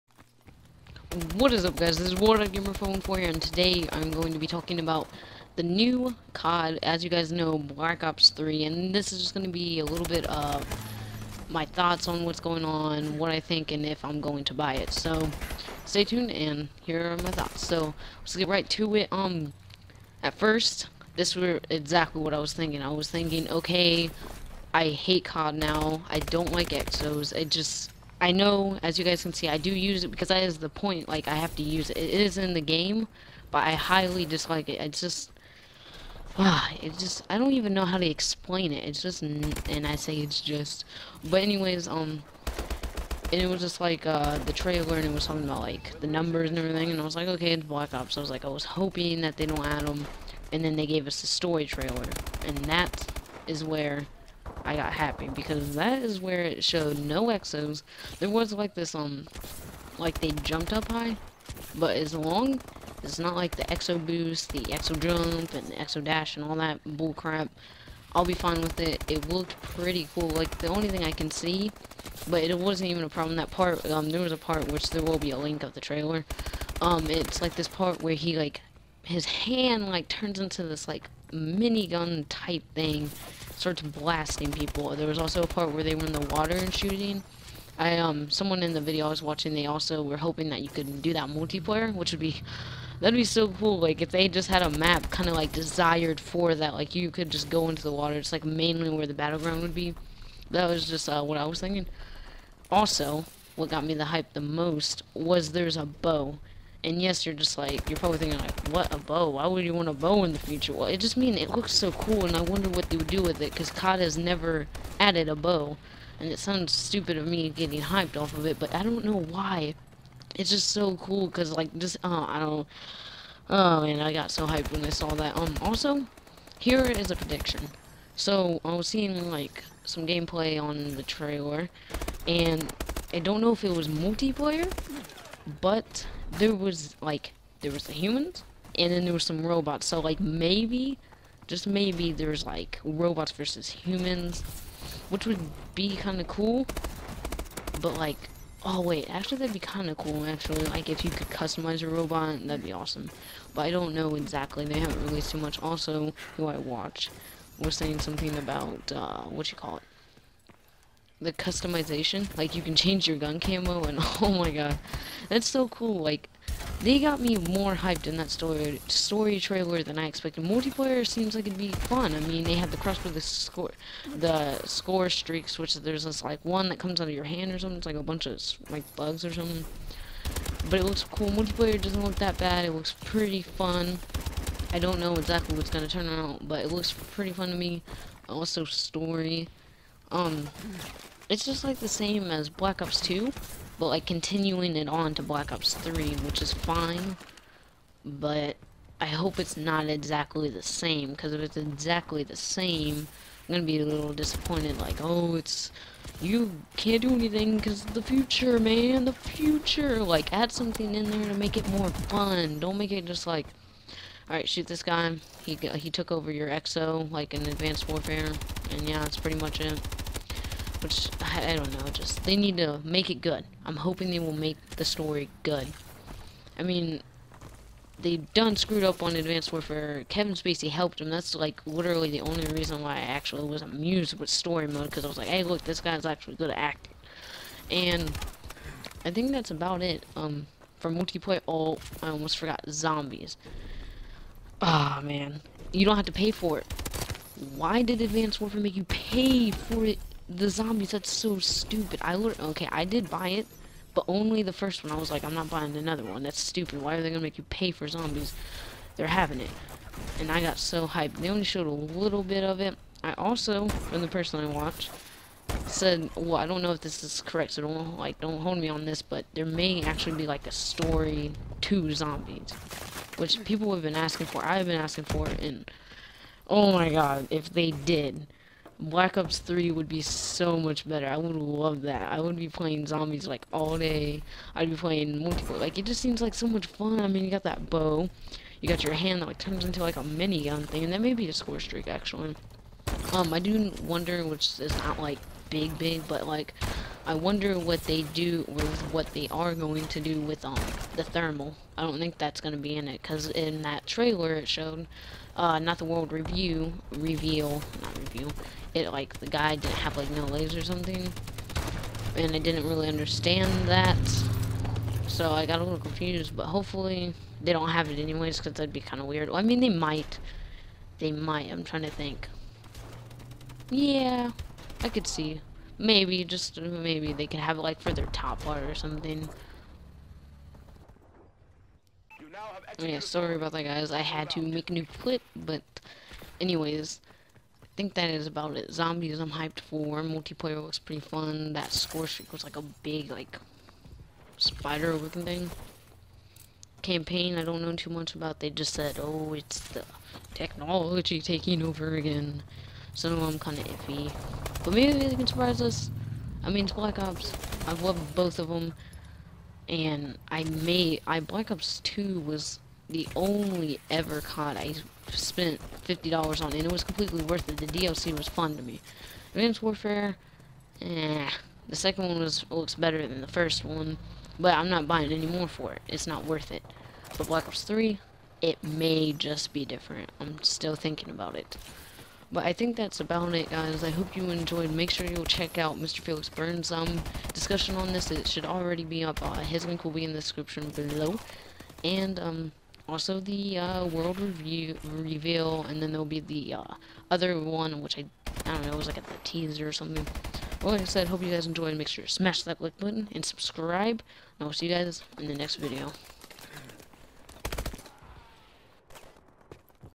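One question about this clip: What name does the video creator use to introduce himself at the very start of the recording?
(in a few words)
Warlock Gamer.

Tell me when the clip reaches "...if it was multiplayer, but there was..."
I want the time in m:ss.
2:13.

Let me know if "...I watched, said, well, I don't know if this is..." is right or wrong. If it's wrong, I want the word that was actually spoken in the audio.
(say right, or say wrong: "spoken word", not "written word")
right.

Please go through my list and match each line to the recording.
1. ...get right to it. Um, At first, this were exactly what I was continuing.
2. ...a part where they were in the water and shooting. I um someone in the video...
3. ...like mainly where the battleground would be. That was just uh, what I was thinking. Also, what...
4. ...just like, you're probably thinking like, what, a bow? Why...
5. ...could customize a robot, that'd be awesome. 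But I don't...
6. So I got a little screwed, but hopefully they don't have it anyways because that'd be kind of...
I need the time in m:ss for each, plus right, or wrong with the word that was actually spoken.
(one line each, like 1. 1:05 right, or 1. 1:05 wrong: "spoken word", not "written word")
1. 0:18 wrong: "thinking", not "continuing"
2. 1:25 right
3. 1:38 right
4. 1:47 right
5. 2:31 right
6. 5:15 wrong: "confused", not "screwed".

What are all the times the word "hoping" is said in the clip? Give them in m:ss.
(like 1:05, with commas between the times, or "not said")
0:48, 1:30, 3:43.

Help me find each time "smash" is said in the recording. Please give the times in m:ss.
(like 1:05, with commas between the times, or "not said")
6:42.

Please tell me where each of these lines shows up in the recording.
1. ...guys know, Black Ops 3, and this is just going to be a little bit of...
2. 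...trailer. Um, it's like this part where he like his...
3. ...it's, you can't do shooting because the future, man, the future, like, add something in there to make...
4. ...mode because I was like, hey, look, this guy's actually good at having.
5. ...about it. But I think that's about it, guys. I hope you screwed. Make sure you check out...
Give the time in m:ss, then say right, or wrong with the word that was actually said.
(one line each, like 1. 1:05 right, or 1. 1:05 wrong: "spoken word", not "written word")
1. 0:07 right
2. 1:15 right
3. 3:25 wrong: "anything", not "shooting"
4. 3:54 wrong: "acting", not "having"
5. 6:21 wrong: "enjoyed", not "screwed".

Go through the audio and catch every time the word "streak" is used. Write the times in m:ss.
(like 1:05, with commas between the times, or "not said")
2:55, 4:51, 5:42.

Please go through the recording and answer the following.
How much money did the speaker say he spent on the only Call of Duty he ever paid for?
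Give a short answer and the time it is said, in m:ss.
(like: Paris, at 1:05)
$50, at 6:05.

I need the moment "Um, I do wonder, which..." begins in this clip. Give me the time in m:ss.
4:53.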